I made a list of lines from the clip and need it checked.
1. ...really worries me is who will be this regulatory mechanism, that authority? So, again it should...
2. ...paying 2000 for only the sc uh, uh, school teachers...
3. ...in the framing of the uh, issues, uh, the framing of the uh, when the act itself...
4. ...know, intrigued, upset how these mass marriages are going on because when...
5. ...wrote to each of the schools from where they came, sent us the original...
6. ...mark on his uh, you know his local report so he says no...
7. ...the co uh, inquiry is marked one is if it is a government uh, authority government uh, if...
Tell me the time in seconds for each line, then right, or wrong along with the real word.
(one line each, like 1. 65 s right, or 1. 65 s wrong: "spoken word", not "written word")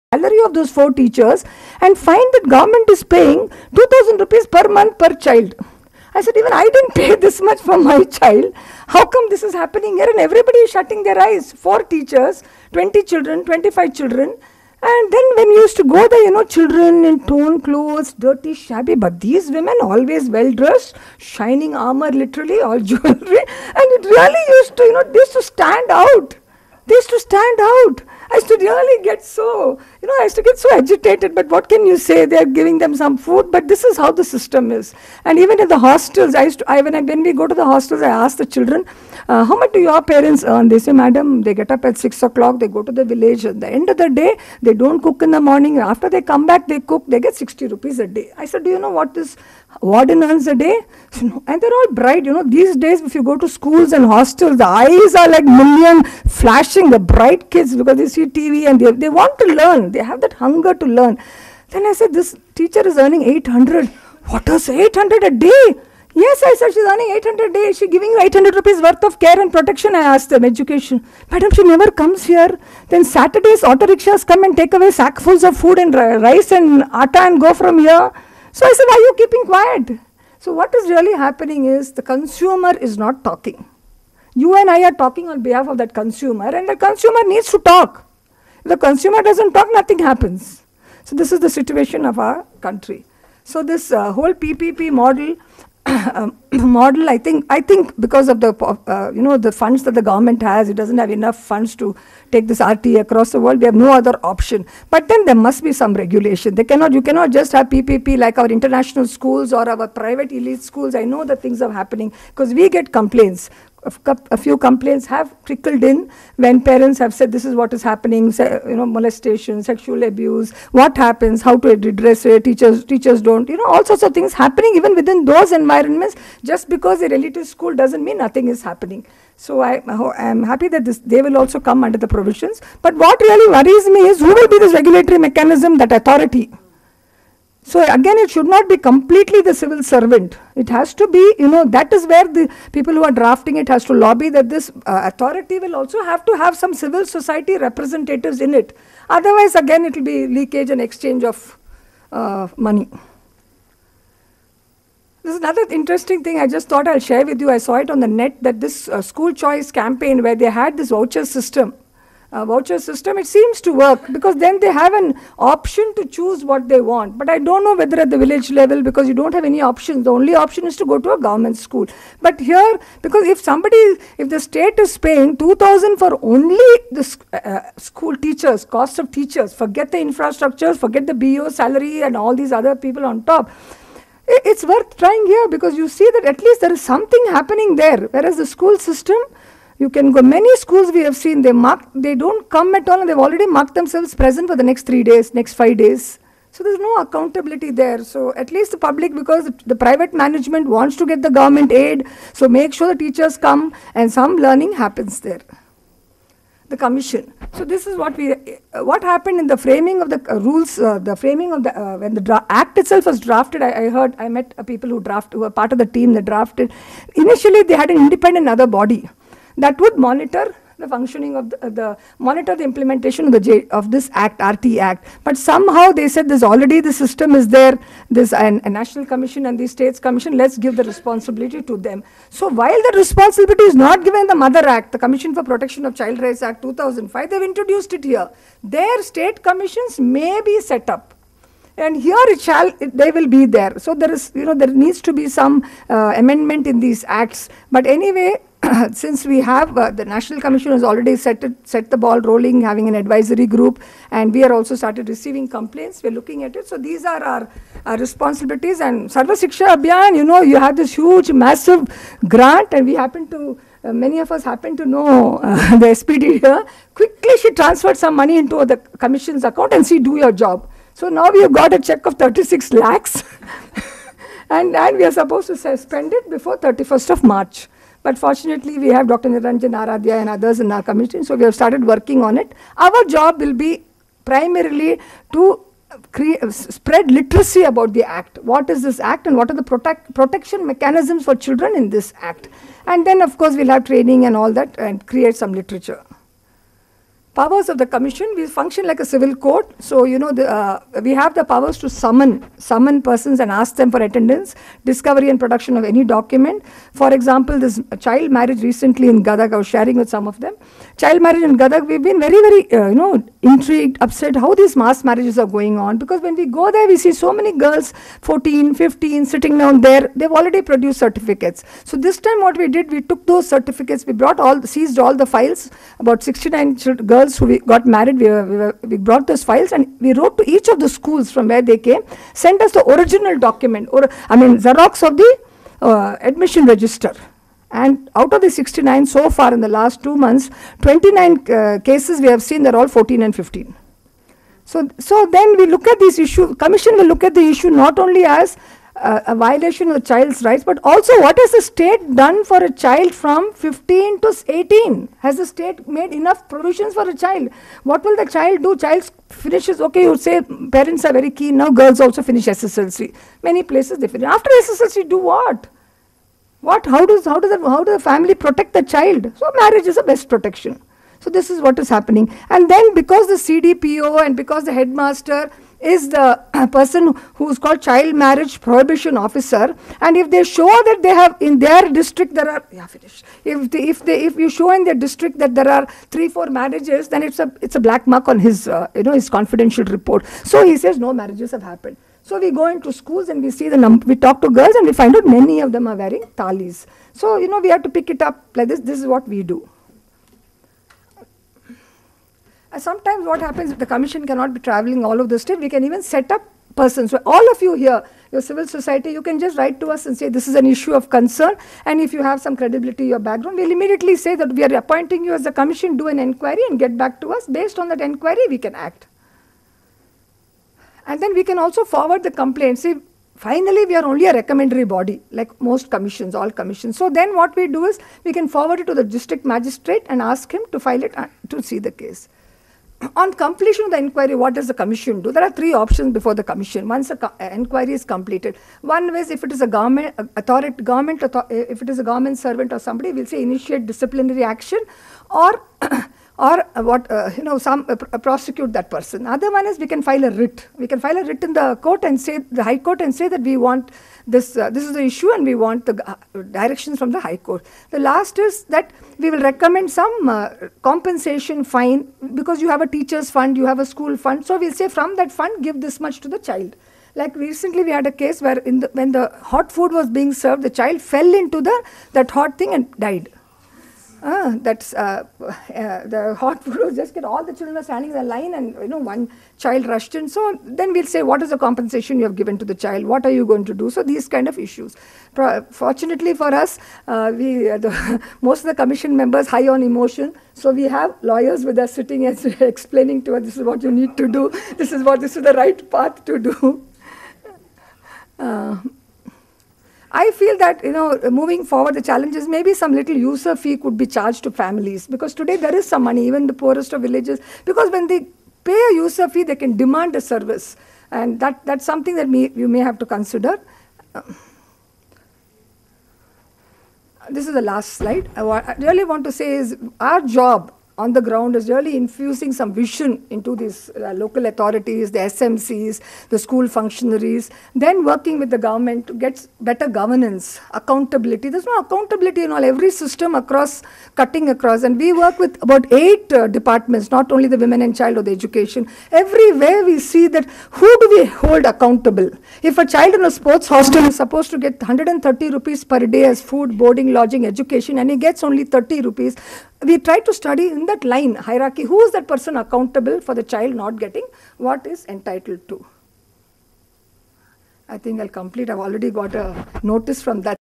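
1. 133 s right
2. 174 s right
3. 209 s wrong: "rules", not "issues"
4. 312 s right
5. 330 s right
6. 388 s wrong: "confidential", not "local"
7. 437 s wrong: "completed", not "marked".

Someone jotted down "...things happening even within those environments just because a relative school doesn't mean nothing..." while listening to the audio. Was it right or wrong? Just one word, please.
right.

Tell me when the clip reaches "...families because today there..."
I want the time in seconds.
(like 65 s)
504 s.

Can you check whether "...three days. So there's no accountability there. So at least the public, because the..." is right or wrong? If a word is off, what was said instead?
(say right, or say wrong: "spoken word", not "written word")
wrong: "five", not "three".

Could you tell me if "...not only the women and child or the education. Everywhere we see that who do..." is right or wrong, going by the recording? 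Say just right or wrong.
right.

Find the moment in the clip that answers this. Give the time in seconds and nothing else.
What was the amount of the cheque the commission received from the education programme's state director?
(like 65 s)
272 s.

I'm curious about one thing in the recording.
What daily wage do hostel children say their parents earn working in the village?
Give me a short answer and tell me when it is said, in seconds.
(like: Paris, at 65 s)
60 rupees, at 47 s.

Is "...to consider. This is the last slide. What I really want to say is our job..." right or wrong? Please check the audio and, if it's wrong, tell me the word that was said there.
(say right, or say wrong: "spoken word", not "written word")
right.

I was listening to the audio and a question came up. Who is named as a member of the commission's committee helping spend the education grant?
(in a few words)
Dr. Niranjan Aradhya.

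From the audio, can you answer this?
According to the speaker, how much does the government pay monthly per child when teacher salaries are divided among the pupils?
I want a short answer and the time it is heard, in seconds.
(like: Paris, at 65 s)
2000 rupees, at 3 s.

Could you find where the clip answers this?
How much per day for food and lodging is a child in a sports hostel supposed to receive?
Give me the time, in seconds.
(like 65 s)
544 s.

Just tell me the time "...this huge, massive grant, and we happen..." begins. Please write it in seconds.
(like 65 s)
260 s.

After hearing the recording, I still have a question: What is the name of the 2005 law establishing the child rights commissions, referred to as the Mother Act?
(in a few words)
Commission for Protection of Child Rights Act.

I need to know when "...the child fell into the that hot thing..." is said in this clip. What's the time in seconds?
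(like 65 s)
470 s.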